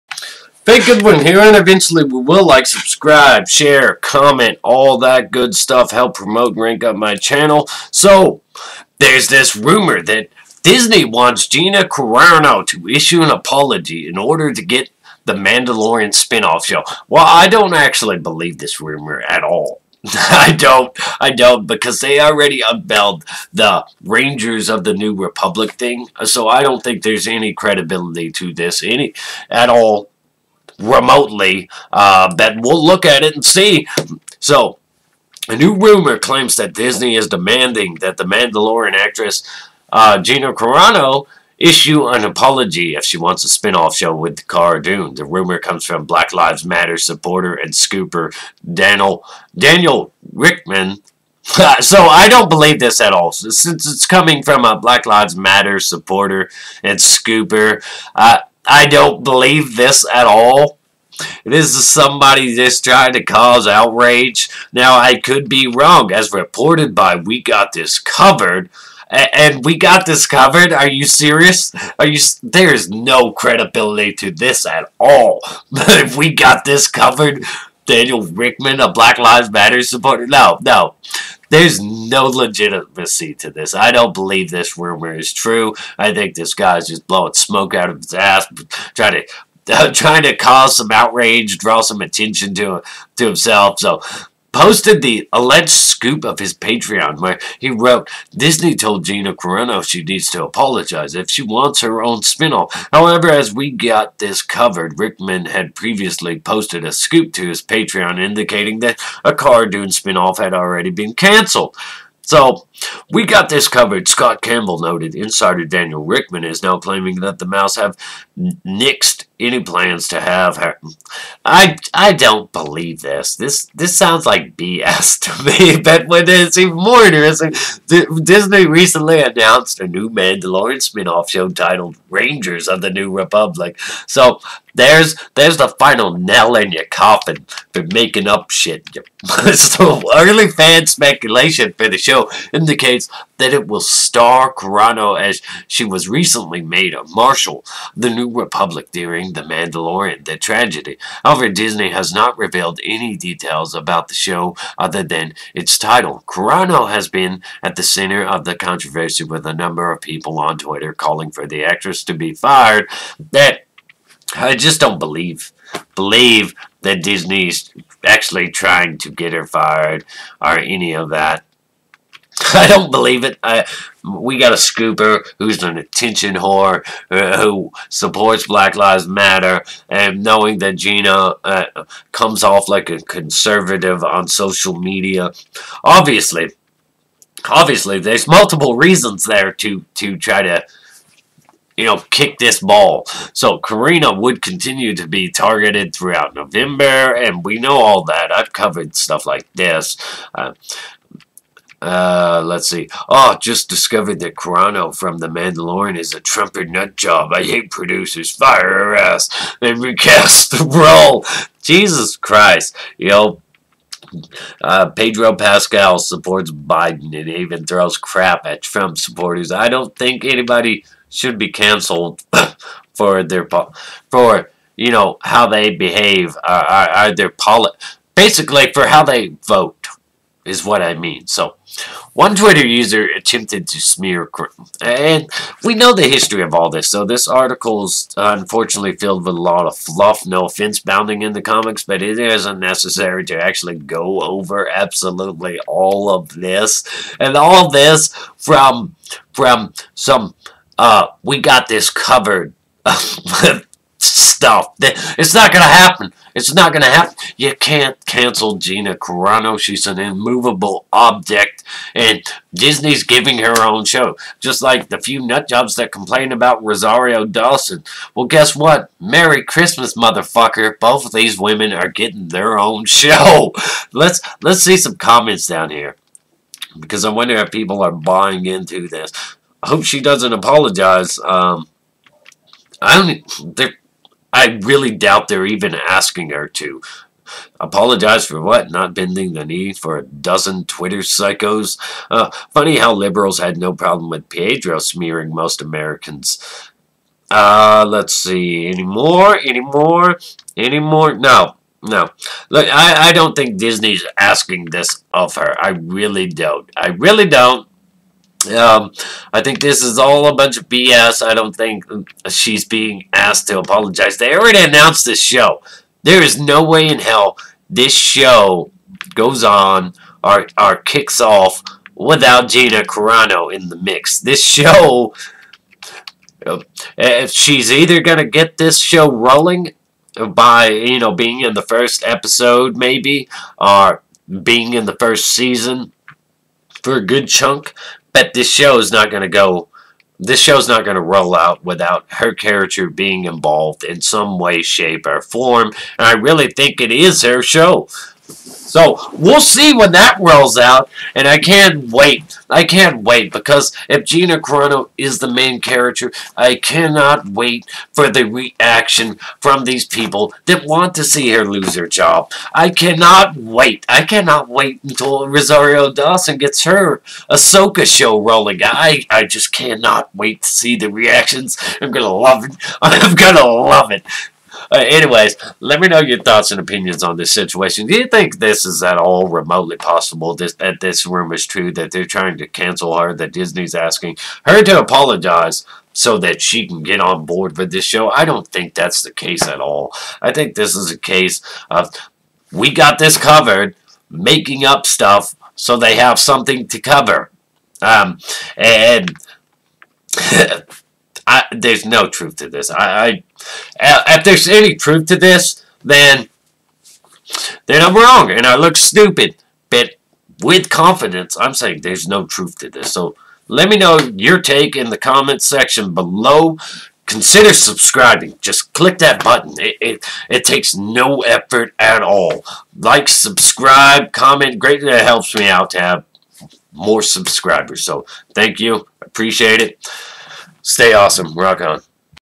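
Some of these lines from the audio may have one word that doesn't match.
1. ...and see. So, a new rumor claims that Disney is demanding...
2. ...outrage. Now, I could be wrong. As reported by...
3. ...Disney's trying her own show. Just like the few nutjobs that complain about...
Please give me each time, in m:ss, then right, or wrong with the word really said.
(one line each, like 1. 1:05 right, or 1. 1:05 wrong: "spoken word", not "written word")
1. 0:33 right
2. 1:03 right
3. 4:22 wrong: "giving", not "trying".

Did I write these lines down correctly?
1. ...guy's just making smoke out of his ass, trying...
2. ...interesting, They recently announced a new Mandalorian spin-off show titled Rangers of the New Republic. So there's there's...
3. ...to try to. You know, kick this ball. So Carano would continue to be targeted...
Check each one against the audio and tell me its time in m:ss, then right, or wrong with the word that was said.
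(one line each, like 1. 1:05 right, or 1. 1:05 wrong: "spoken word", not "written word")
1. 1:26 wrong: "blowing", not "making"
2. 2:07 wrong: "Disney", not "They"
3. 3:09 right.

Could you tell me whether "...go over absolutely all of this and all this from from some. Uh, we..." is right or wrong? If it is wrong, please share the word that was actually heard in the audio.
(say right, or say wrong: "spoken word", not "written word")
right.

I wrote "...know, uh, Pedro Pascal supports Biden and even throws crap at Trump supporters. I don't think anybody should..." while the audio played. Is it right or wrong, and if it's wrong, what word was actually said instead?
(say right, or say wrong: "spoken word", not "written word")
right.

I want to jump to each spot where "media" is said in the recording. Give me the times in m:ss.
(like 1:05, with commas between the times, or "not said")
3:04.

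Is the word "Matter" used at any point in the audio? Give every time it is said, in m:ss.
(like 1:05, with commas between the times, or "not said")
0:46, 0:55, 1:19, 2:59.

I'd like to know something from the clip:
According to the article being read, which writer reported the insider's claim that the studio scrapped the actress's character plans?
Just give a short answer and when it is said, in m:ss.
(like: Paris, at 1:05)
Scott Campbell, at 1:54.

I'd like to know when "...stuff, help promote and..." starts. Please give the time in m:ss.
0:05.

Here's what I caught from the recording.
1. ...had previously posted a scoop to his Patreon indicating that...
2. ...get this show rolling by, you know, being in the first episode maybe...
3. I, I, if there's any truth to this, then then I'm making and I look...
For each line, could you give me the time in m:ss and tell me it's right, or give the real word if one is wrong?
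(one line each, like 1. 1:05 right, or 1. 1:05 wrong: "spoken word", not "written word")
1. 1:45 right
2. 5:28 right
3. 6:42 wrong: "wrong", not "making".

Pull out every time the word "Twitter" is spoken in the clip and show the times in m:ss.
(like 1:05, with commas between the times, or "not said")
2:40, 3:52, 4:50.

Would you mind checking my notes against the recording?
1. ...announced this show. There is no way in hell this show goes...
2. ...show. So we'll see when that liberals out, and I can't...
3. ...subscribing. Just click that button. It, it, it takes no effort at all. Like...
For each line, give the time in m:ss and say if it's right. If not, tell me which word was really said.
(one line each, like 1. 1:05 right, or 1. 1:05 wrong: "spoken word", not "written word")
1. 5:14 right
2. 5:47 wrong: "rolls", not "liberals"
3. 6:57 right.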